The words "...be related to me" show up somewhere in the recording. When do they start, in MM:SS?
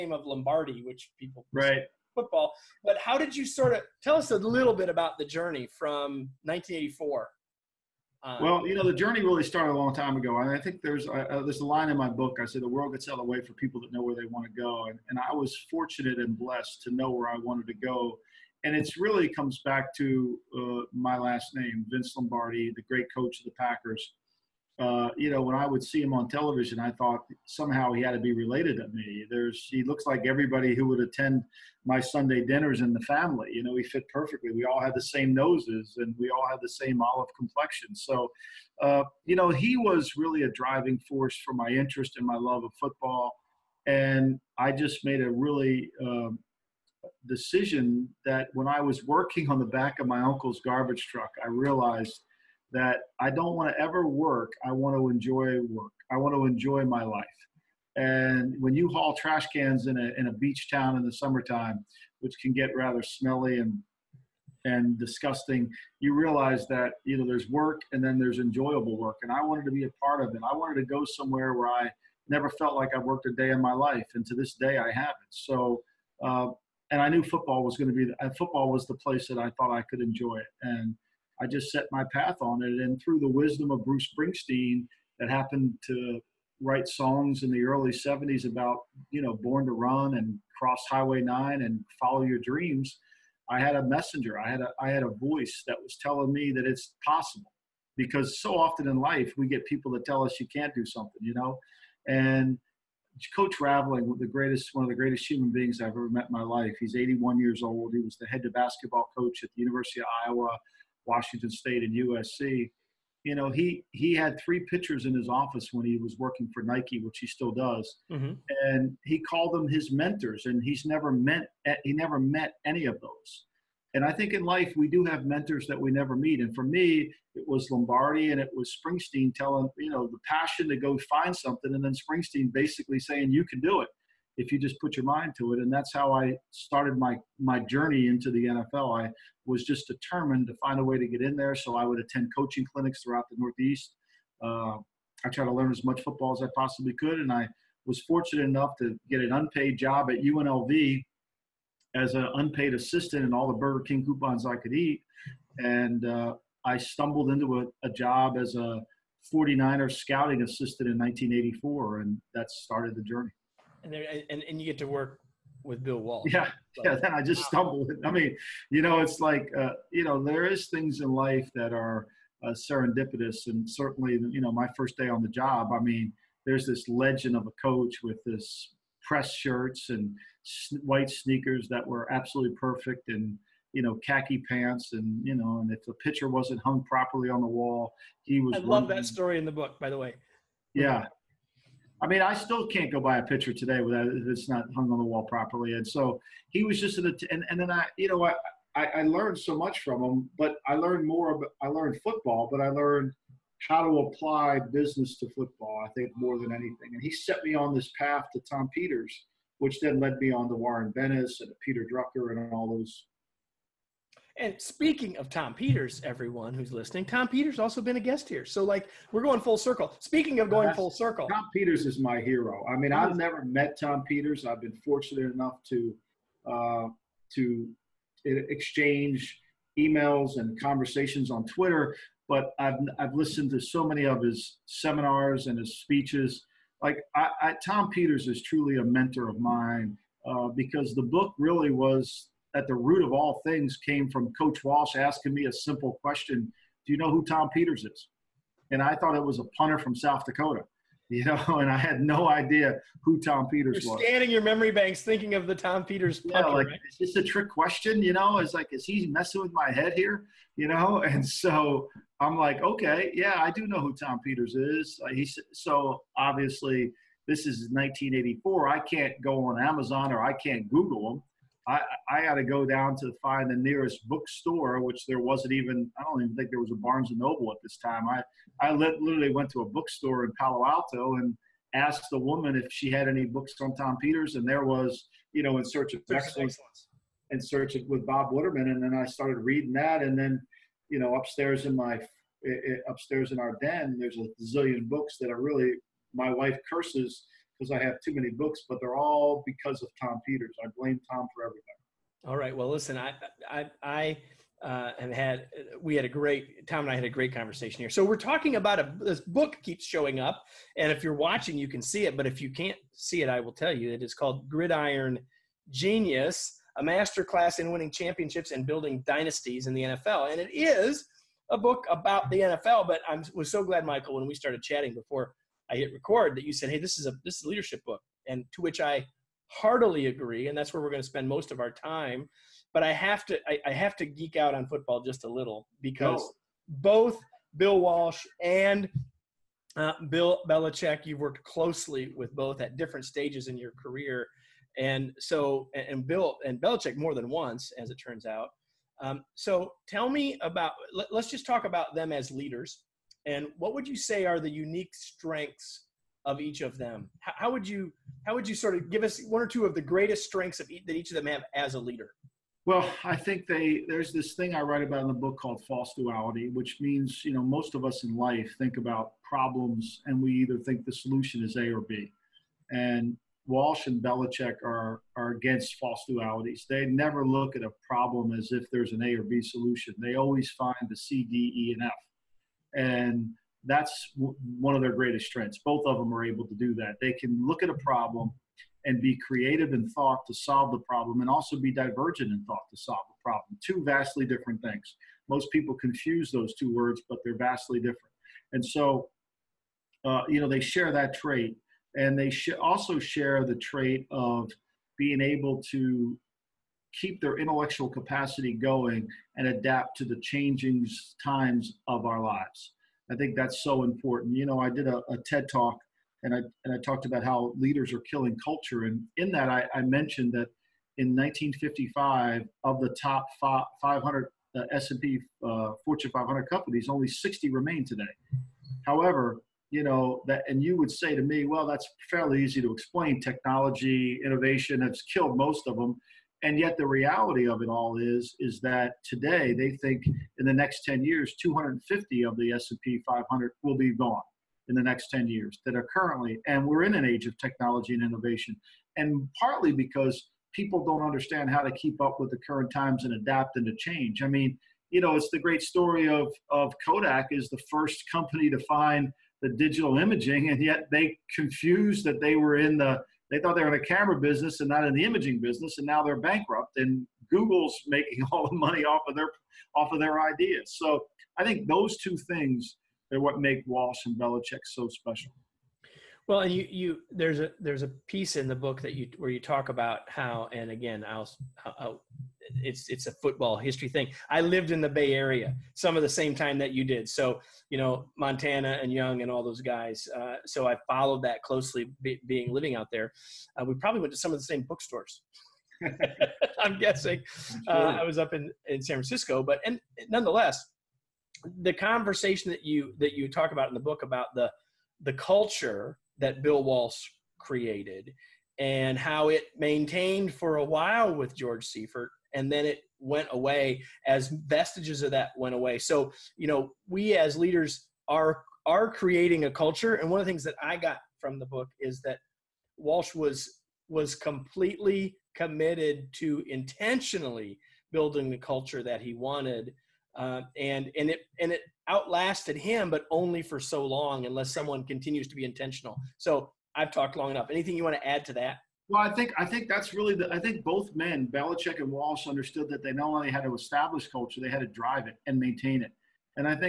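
00:28.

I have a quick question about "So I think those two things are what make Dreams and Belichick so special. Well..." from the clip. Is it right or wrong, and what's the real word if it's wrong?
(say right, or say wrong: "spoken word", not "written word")
wrong: "Walsh", not "Dreams".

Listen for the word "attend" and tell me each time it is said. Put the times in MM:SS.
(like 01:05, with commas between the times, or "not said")
00:31, 02:21.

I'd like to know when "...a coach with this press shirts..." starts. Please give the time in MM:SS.
02:57.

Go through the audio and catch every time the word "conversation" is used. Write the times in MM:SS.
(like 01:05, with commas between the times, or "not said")
03:50, 05:07, 08:21.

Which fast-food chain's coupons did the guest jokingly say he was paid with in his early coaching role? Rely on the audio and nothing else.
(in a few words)
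Burger King.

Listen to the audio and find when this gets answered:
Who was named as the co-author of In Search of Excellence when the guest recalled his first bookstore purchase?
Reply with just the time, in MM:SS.
04:48.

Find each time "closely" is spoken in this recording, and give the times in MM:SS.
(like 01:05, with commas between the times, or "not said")
05:41, 08:11.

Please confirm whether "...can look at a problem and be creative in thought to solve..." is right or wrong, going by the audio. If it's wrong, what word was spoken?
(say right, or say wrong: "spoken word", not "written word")
right.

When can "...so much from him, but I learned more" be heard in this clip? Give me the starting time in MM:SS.
03:19.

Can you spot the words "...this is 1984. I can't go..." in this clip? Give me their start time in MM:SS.
04:27.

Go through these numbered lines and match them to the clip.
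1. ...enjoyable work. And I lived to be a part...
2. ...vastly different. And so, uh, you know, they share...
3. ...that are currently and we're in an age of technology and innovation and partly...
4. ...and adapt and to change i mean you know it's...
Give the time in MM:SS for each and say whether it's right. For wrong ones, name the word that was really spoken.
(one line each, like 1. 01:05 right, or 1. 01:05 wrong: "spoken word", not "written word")
1. 01:08 wrong: "wanted", not "lived"
2. 06:37 right
3. 07:25 right
4. 07:33 right.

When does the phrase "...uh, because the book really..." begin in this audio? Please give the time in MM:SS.
04:00.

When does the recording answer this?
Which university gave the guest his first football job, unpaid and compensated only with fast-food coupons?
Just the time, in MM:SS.
02:30.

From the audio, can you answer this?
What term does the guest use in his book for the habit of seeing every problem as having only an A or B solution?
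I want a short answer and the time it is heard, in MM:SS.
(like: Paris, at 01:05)
False duality, at 06:05.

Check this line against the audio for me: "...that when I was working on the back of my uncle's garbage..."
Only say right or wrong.
right.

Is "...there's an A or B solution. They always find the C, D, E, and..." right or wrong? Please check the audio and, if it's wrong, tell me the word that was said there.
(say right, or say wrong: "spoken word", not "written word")
right.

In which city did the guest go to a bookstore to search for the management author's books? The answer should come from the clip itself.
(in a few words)
Palo Alto.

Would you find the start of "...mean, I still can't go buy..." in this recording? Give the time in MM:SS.
03:12.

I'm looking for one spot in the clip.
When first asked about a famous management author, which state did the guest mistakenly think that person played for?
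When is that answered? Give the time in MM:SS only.
04:09.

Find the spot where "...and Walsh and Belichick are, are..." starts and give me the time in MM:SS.
06:12.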